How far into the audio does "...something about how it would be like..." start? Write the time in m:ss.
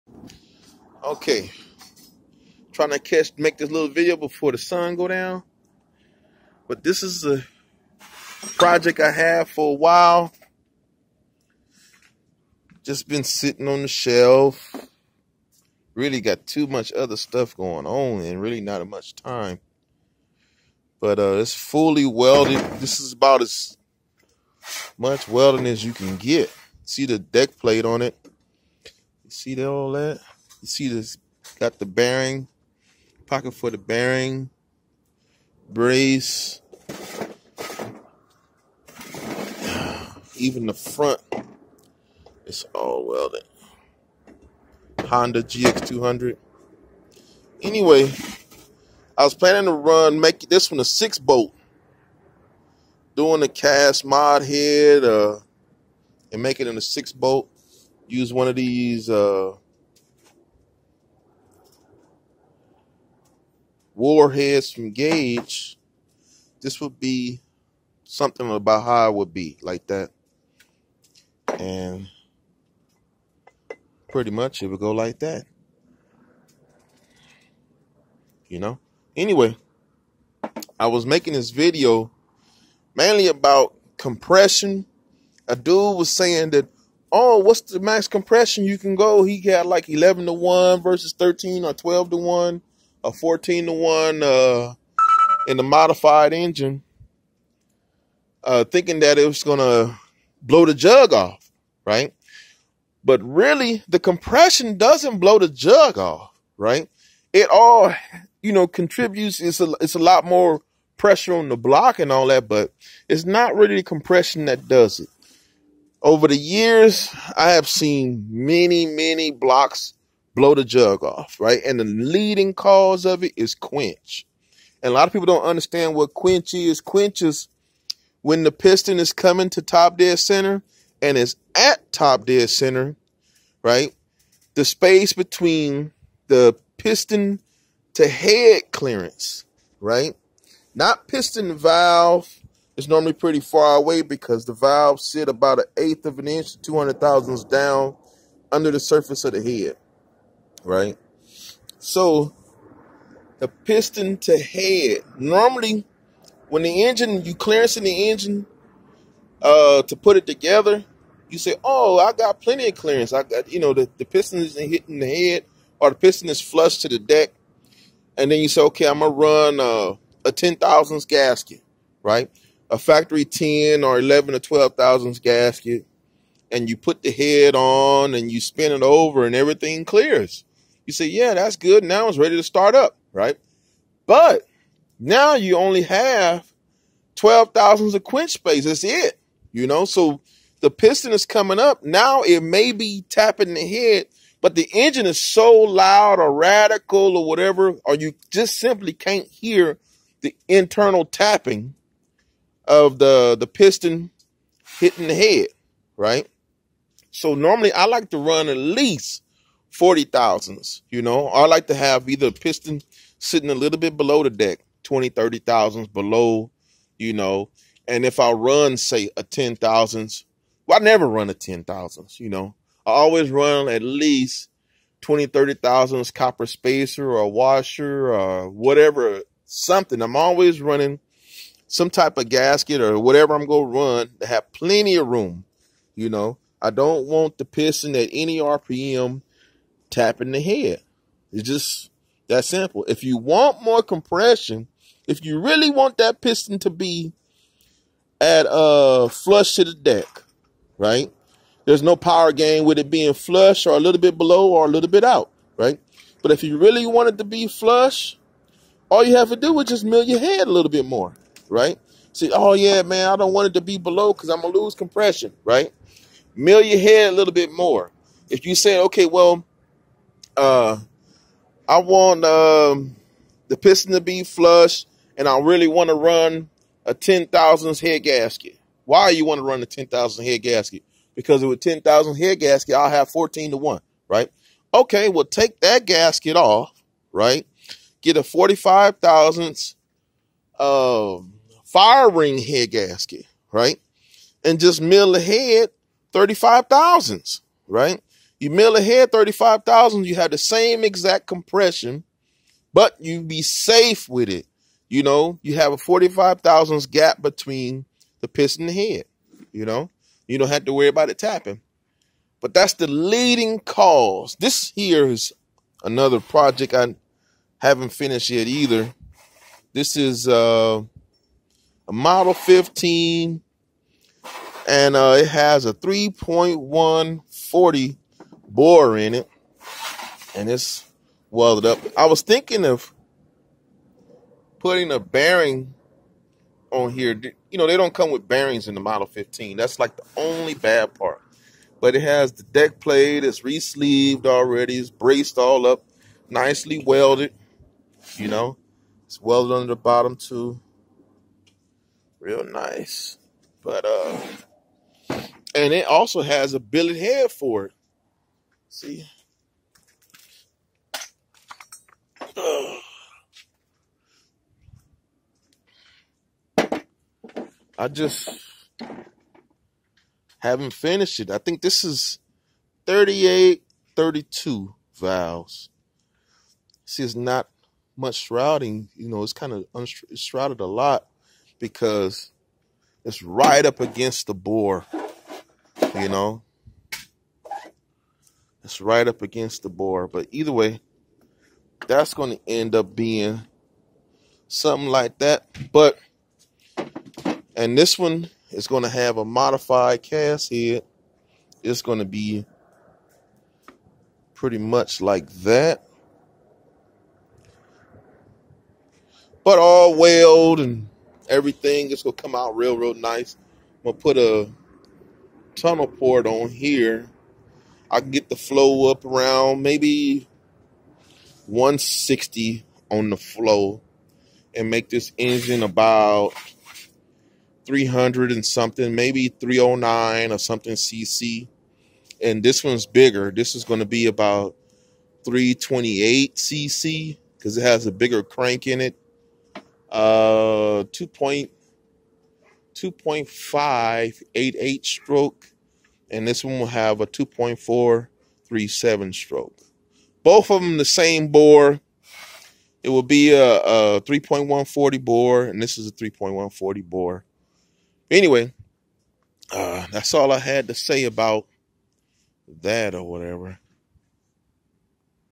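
1:08.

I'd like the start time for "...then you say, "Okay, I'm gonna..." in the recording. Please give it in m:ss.
2:48.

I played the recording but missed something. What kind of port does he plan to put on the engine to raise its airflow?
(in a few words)
Tunnel port.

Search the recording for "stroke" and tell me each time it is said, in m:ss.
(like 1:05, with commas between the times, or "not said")
7:24, 7:29.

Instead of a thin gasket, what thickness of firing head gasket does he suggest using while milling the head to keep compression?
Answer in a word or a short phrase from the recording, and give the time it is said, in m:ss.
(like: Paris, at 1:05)
45 thousandths, at 4:48.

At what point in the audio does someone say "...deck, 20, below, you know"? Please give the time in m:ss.
3:34.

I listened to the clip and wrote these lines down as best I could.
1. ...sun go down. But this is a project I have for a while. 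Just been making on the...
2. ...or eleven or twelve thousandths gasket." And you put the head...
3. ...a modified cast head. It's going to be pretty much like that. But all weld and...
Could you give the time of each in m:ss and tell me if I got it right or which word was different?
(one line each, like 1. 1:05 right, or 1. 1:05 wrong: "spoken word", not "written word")
1. 0:04 wrong: "sitting", not "making"
2. 2:53 right
3. 6:39 right.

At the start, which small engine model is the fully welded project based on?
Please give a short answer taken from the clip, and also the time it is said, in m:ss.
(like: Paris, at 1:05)
Honda GX200, at 0:45.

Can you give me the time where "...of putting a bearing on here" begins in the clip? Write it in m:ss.
5:32.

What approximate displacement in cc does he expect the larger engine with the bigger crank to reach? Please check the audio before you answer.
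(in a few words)
328 cc.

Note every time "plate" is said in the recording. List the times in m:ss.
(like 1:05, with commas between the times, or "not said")
0:27, 5:42.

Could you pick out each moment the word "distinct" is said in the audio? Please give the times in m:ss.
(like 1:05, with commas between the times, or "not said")
not said.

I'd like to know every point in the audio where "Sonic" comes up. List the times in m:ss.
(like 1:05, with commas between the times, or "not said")
not said.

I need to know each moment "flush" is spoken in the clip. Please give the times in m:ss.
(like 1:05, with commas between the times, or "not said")
2:46, 4:09, 4:13, 4:17, 4:34.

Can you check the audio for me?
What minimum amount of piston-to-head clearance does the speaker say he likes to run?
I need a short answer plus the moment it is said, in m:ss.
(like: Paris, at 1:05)
40 thousandths, at 3:29.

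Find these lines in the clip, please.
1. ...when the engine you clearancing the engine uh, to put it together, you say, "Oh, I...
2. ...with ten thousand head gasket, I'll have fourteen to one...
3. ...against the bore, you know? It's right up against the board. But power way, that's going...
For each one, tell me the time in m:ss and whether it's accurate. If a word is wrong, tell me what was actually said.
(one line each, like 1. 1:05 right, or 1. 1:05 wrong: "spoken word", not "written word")
1. 2:36 right
2. 4:41 right
3. 6:23 wrong: "either", not "power".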